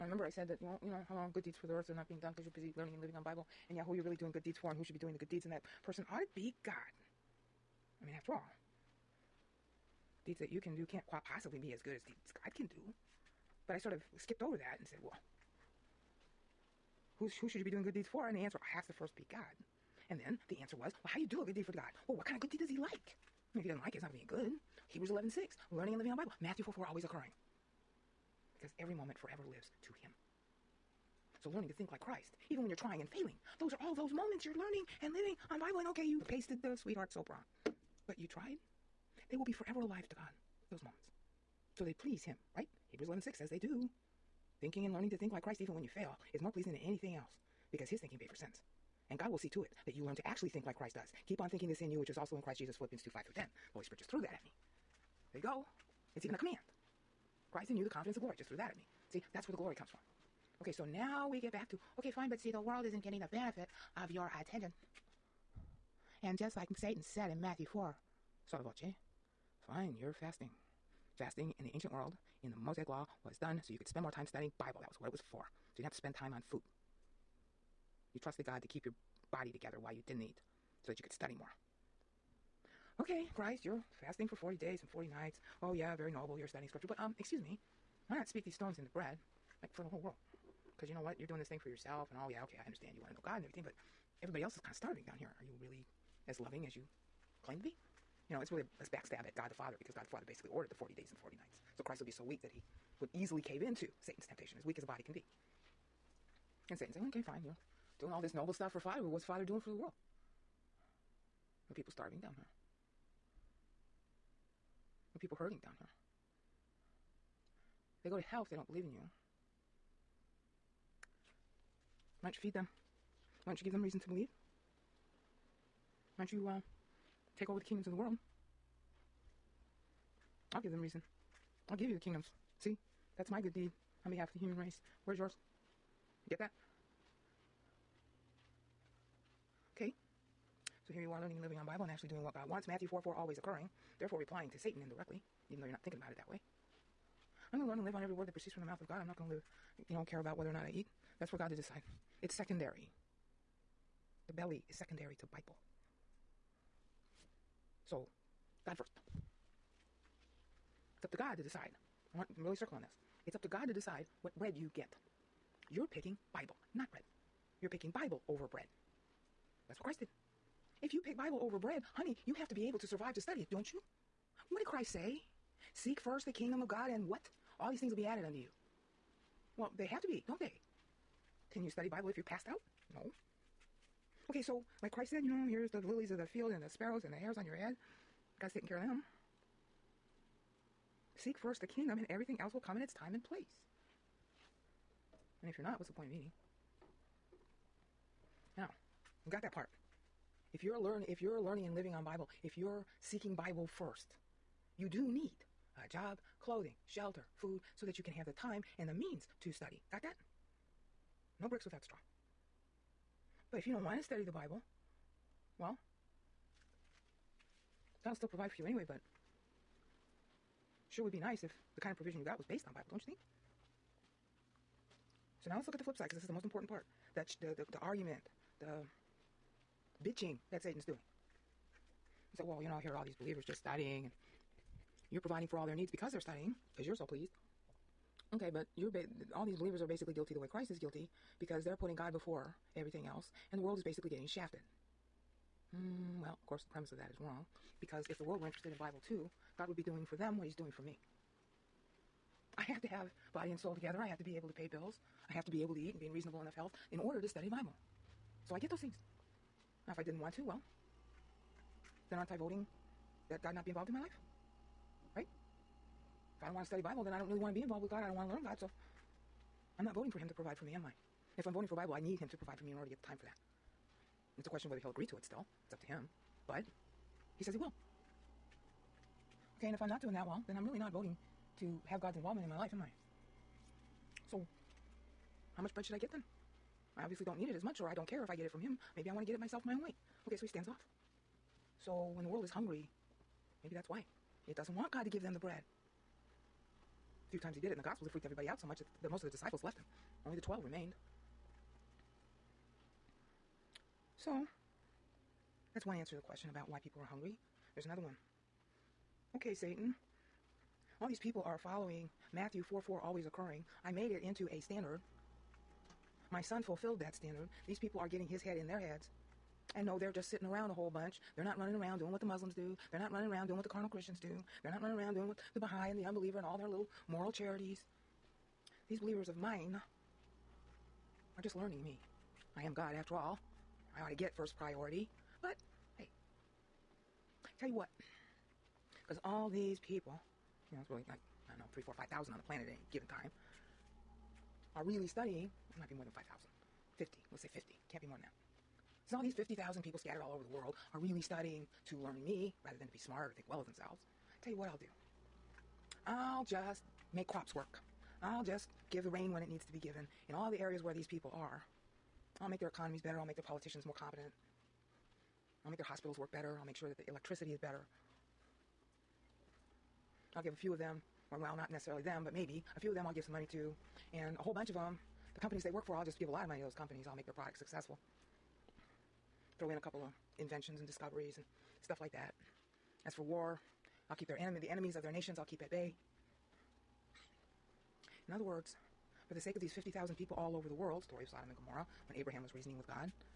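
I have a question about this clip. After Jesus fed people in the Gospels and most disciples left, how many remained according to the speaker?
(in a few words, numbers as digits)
12.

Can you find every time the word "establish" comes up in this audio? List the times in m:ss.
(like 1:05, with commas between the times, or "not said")
not said.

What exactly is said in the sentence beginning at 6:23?
As for war, I'll keep their enemy, the enemies of their nations, I'll keep at bay.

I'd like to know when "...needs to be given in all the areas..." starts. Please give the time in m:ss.
5:59.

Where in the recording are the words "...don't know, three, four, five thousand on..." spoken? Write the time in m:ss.
5:41.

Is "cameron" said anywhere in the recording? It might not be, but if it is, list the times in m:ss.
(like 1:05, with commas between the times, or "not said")
not said.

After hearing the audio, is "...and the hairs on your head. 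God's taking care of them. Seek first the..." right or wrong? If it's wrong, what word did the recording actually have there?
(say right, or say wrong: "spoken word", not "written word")
right.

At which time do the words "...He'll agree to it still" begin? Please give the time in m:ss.
4:34.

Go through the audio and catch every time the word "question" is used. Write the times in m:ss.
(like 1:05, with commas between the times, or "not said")
4:34, 5:06.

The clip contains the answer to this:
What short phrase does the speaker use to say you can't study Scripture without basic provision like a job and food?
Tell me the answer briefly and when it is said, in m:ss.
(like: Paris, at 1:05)
No bricks without straw, at 3:31.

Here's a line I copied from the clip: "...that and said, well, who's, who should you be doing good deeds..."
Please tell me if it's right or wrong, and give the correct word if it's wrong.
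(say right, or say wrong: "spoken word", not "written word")
right.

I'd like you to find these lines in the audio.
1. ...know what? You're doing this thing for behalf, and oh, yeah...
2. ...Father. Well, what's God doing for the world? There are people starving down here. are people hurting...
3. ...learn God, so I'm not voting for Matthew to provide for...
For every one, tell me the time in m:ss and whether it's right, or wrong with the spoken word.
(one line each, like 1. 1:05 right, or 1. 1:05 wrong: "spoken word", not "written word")
1. 1:30 wrong: "yourself", not "behalf"
2. 1:48 wrong: "Father", not "God"
3. 4:28 wrong: "Him", not "Matthew".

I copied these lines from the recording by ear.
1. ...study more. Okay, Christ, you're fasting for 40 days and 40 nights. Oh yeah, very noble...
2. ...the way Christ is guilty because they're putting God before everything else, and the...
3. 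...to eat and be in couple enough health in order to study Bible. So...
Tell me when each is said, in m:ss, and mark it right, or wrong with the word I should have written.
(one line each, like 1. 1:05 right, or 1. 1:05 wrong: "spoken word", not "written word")
1. 1:21 right
2. 4:00 right
3. 4:15 wrong: "reasonable", not "couple".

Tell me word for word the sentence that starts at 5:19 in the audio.
And no, they're just sitting around a whole bunch.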